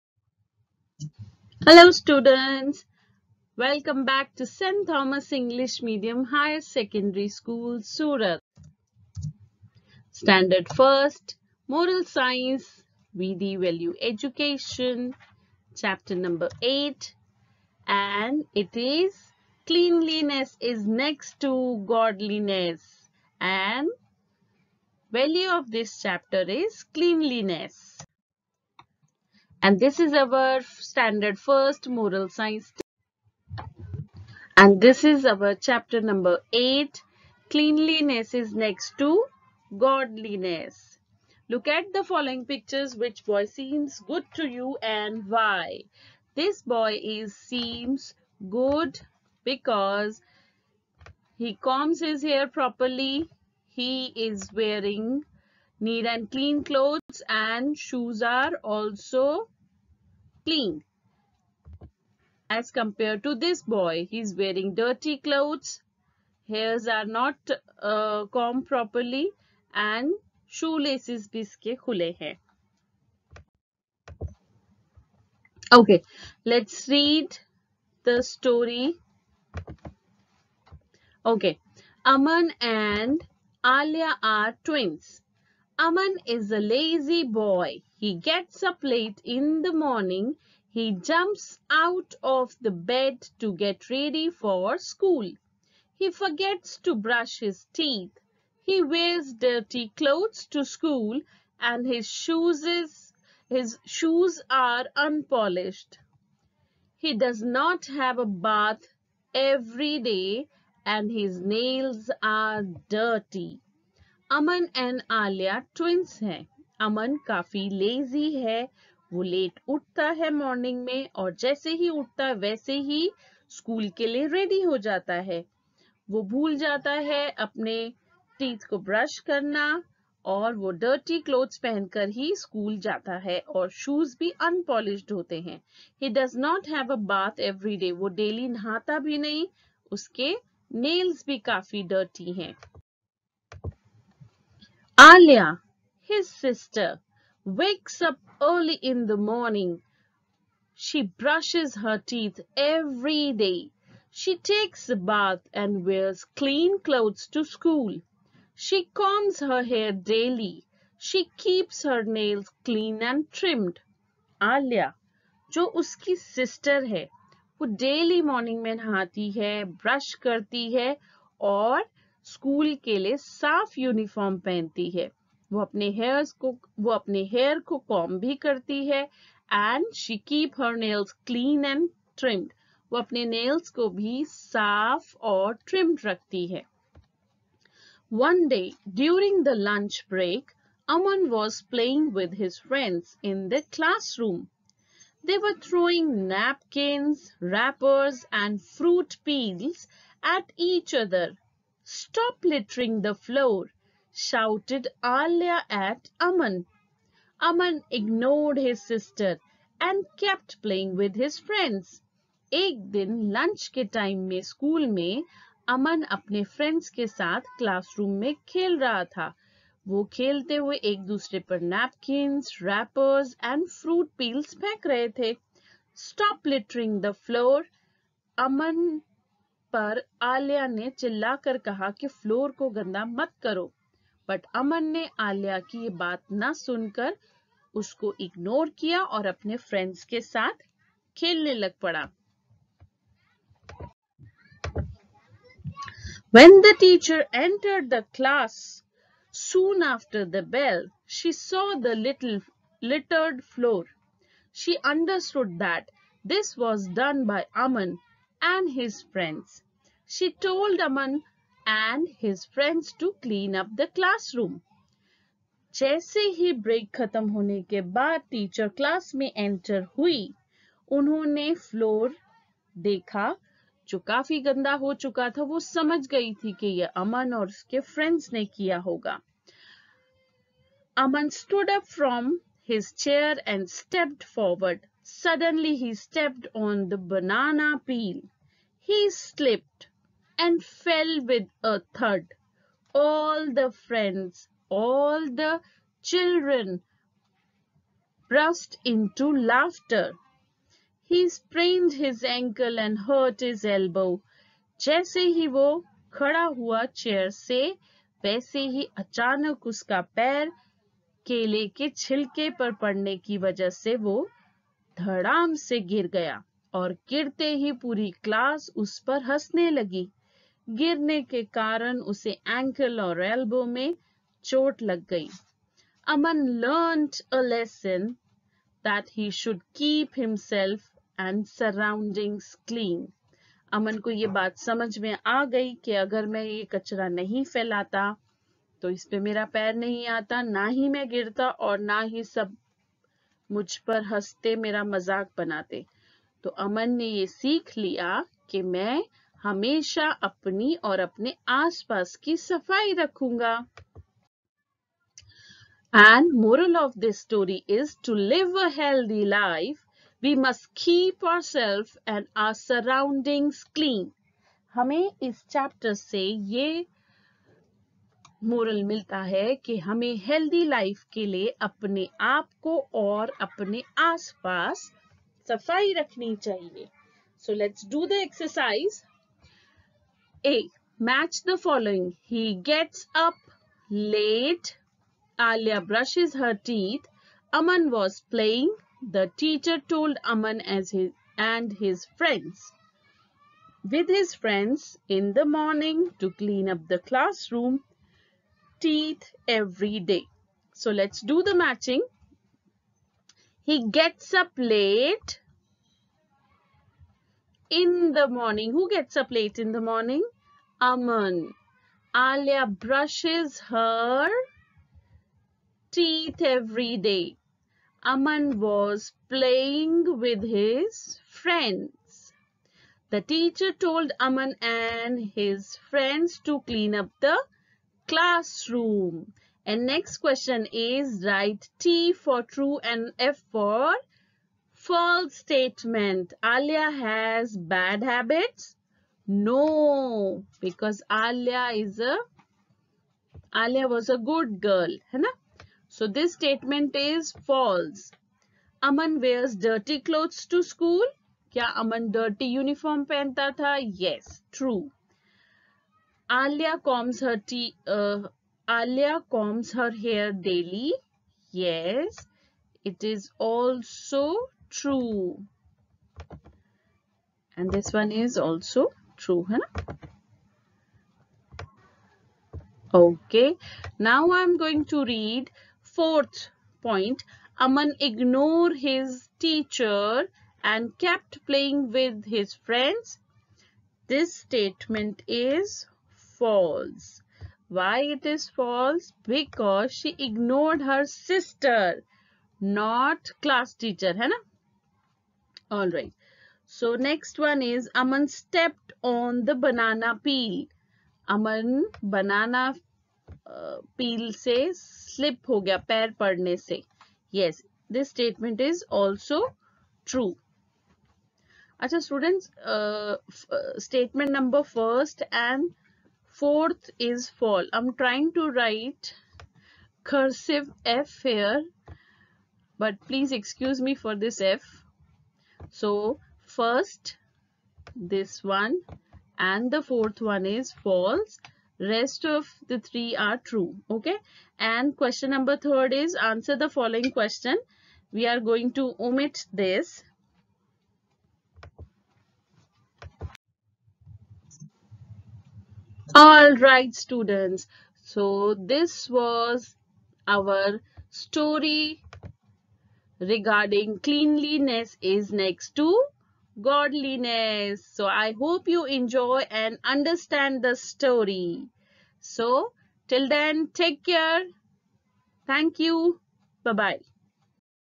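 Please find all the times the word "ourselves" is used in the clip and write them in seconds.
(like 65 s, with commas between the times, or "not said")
361 s.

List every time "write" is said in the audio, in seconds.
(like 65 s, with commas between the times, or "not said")
431 s, 518 s.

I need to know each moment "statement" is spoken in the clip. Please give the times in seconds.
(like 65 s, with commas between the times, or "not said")
435 s, 446 s, 484 s, 508 s, 513 s.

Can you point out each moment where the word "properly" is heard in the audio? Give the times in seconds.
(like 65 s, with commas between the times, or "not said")
52 s, 68 s.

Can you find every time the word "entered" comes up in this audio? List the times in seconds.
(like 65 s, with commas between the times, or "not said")
247 s.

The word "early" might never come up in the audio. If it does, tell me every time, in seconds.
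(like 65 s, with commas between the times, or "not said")
148 s.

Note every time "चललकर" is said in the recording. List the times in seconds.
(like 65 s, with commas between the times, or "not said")
231 s.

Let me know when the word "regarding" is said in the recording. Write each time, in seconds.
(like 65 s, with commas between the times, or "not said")
553 s.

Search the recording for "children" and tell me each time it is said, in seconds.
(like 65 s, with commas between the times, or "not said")
296 s.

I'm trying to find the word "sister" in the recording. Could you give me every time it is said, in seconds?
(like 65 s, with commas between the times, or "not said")
146 s, 166 s, 208 s, 491 s.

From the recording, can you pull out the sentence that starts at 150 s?
She brushes her teeth every day.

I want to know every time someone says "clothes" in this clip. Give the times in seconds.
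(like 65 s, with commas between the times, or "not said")
56 s, 65 s, 99 s, 156 s, 450 s.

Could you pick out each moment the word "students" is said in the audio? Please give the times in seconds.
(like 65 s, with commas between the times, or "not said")
1 s, 512 s, 546 s.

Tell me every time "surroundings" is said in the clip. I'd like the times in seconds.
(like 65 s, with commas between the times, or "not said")
331 s, 362 s.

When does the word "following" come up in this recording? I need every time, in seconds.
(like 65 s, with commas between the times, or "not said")
42 s, 536 s.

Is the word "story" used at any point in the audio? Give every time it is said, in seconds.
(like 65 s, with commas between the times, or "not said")
78 s, 357 s, 551 s, 560 s.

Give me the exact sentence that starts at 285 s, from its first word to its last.
Suddenly he stepped on the banana peel.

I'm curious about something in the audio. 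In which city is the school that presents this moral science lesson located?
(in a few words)
Surat.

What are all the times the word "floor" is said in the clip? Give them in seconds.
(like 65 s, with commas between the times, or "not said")
203 s, 253 s.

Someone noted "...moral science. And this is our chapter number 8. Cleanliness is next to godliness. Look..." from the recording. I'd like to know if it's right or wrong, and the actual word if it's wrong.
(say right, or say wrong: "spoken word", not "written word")
right.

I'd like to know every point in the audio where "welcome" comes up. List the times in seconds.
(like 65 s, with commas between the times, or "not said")
3 s.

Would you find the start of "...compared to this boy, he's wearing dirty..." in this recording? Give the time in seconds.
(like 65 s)
62 s.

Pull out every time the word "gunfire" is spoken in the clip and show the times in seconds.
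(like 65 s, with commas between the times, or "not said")
not said.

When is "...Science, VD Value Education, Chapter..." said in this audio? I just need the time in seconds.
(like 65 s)
12 s.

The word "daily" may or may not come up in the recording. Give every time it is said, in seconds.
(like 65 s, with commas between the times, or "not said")
159 s, 167 s, 460 s.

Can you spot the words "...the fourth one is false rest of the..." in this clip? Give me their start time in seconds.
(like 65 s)
529 s.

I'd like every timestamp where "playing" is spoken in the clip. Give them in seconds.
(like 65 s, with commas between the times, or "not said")
210 s, 419 s, 481 s.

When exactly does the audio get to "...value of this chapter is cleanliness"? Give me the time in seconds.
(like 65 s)
25 s.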